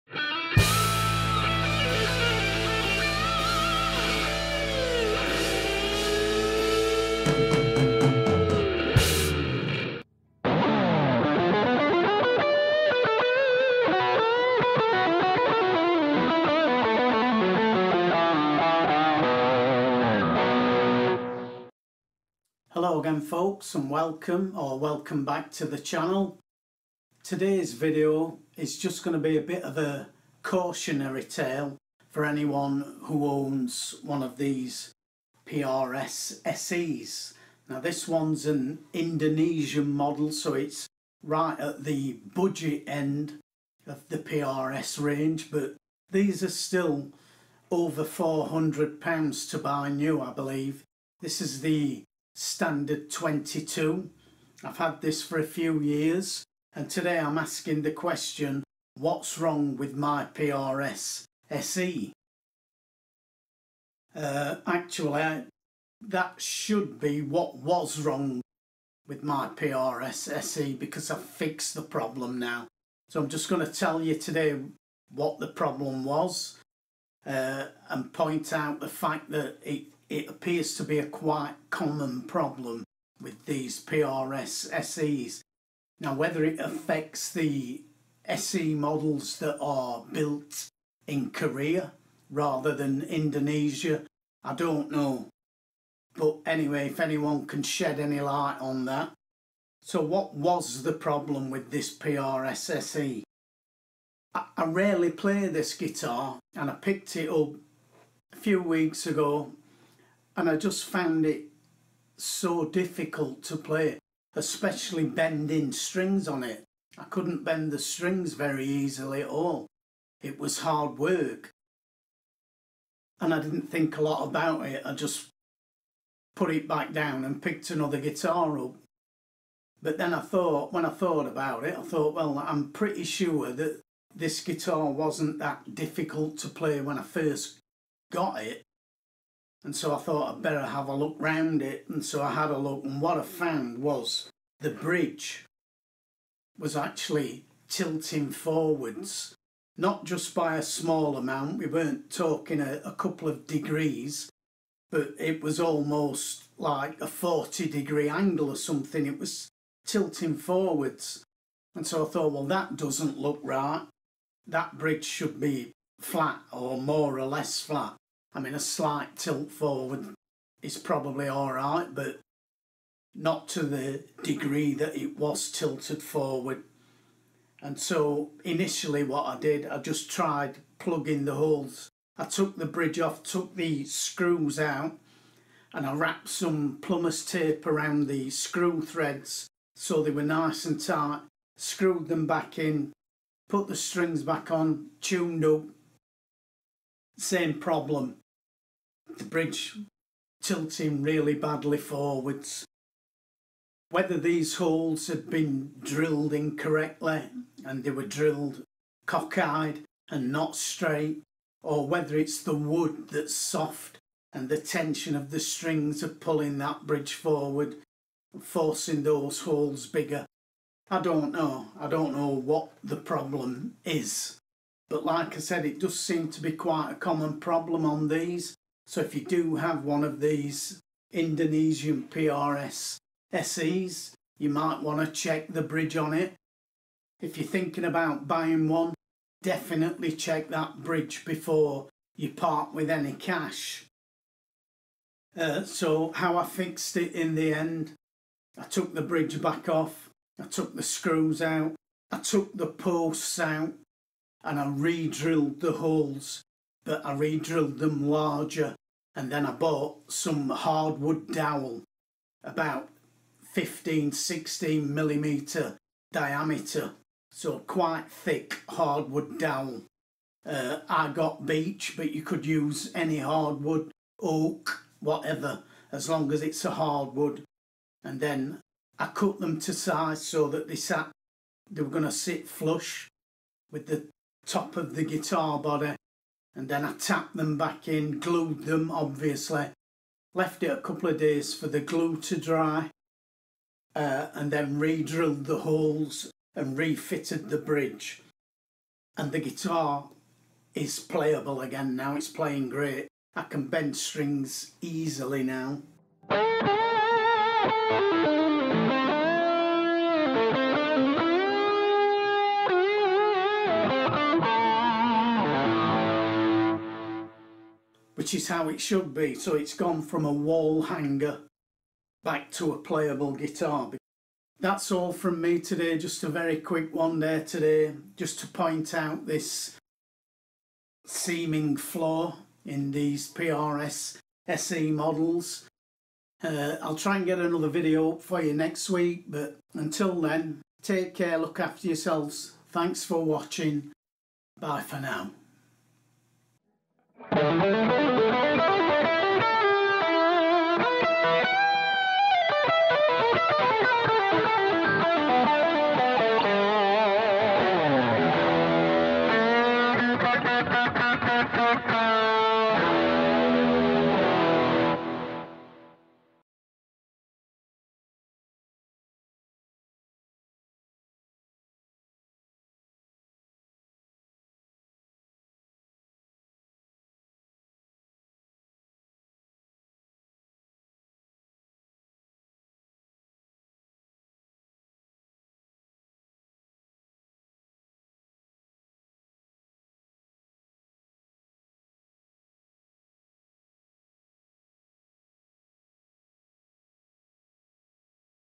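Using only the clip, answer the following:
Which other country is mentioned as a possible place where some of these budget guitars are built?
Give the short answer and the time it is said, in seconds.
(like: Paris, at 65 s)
Korea, at 91 s.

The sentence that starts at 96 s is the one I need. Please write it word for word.
But anyway, if anyone can shed any light on that.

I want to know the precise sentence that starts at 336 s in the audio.
Uh, I'll try and get another video up for you next week, but until then, take care, look after yourselves.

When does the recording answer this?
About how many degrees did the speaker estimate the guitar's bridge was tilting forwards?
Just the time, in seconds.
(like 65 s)
157 s.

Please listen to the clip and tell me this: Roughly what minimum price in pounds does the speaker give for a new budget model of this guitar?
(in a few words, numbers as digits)
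£400.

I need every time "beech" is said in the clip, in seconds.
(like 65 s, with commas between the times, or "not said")
271 s.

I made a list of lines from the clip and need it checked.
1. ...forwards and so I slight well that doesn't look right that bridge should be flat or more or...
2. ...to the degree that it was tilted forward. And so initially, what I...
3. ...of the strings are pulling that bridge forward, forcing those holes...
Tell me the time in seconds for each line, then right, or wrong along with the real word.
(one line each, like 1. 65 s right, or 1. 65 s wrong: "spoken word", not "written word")
1. 160 s wrong: "thought", not "slight"
2. 173 s right
3. 215 s right.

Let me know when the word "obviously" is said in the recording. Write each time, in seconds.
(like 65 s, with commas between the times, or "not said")
288 s.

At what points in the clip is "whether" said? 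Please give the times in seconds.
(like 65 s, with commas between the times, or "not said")
86 s, 203 s, 211 s.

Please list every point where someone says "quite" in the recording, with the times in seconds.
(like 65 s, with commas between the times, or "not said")
81 s, 226 s, 267 s.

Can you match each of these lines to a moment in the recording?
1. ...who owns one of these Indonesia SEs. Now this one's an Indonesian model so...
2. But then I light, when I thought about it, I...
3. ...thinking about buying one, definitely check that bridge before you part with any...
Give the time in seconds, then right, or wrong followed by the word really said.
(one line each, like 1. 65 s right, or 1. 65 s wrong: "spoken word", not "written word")
1. 33 s wrong: "PRS", not "Indonesia"
2. 129 s wrong: "thought", not "light"
3. 237 s right.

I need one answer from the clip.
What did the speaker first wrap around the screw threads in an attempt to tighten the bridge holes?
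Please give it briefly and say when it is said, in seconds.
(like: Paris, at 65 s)
plumber's tape, at 186 s.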